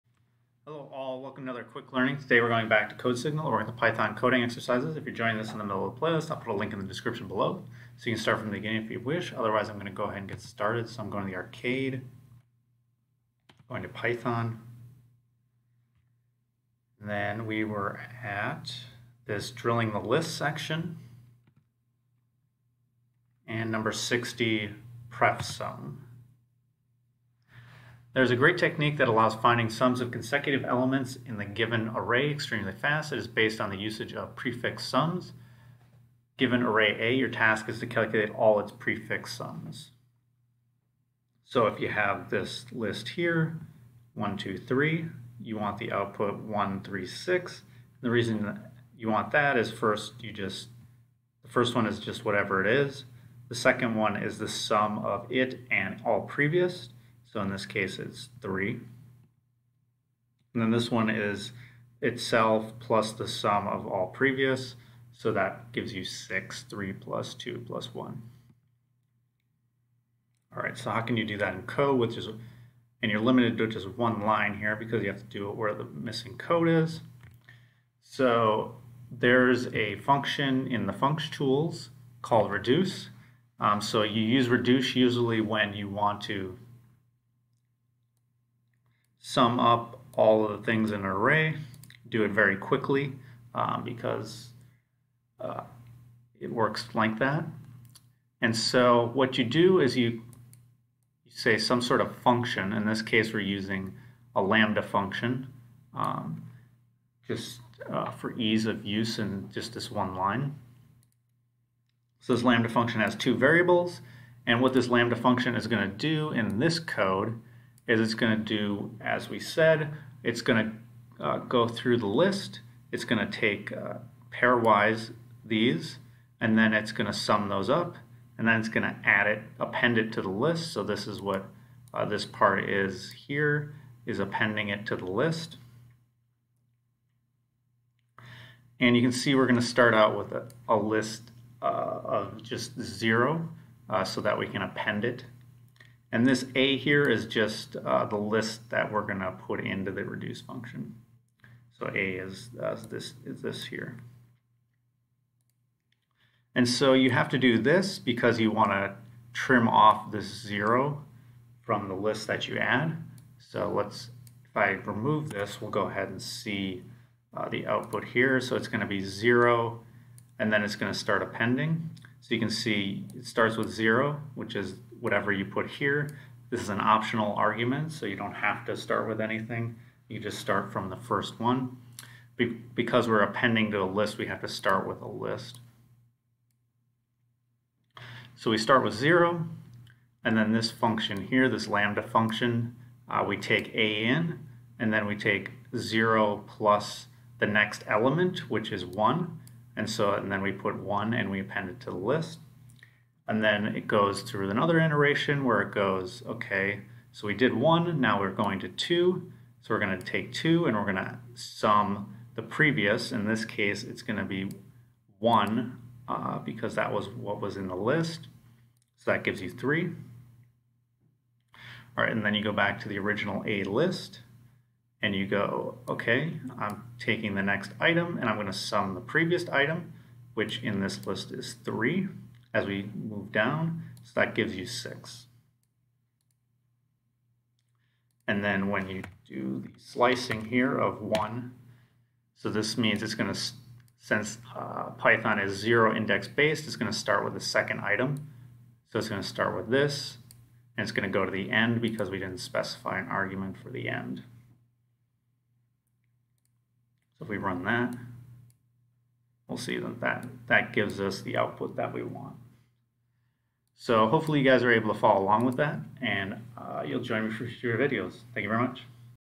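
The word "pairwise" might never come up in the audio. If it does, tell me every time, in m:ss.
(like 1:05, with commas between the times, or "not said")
2:04.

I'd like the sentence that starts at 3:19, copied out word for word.
And so and then we put 1 and we append it to the list.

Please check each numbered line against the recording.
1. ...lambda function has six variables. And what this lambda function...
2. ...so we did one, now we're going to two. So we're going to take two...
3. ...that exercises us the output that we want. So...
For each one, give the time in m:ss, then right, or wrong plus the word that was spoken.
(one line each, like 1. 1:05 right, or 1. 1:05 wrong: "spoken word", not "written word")
1. 1:52 wrong: "two", not "six"
2. 3:27 right
3. 4:20 wrong: "gives", not "exercises".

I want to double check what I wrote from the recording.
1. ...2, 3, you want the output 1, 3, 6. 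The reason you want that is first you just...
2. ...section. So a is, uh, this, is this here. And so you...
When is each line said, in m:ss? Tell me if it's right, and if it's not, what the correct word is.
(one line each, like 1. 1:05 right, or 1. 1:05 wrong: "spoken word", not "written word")
1. 0:44 right
2. 2:30 wrong: "function", not "section".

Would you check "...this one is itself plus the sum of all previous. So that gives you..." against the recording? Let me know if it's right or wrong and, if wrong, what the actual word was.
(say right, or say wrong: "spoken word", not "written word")
right.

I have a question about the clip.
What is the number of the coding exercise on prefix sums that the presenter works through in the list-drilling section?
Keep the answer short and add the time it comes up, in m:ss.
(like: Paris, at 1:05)
60, at 0:23.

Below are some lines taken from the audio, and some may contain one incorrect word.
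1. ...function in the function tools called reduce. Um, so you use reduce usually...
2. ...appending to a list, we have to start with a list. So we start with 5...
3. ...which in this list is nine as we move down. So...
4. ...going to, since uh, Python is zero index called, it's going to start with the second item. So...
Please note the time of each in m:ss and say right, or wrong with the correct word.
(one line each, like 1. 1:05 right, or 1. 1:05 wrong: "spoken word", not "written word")
1. 1:19 right
2. 3:03 wrong: "0", not "5"
3. 3:50 wrong: "three", not "nine"
4. 4:03 wrong: "based", not "called".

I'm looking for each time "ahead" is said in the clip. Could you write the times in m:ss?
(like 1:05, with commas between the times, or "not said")
0:10, 2:45.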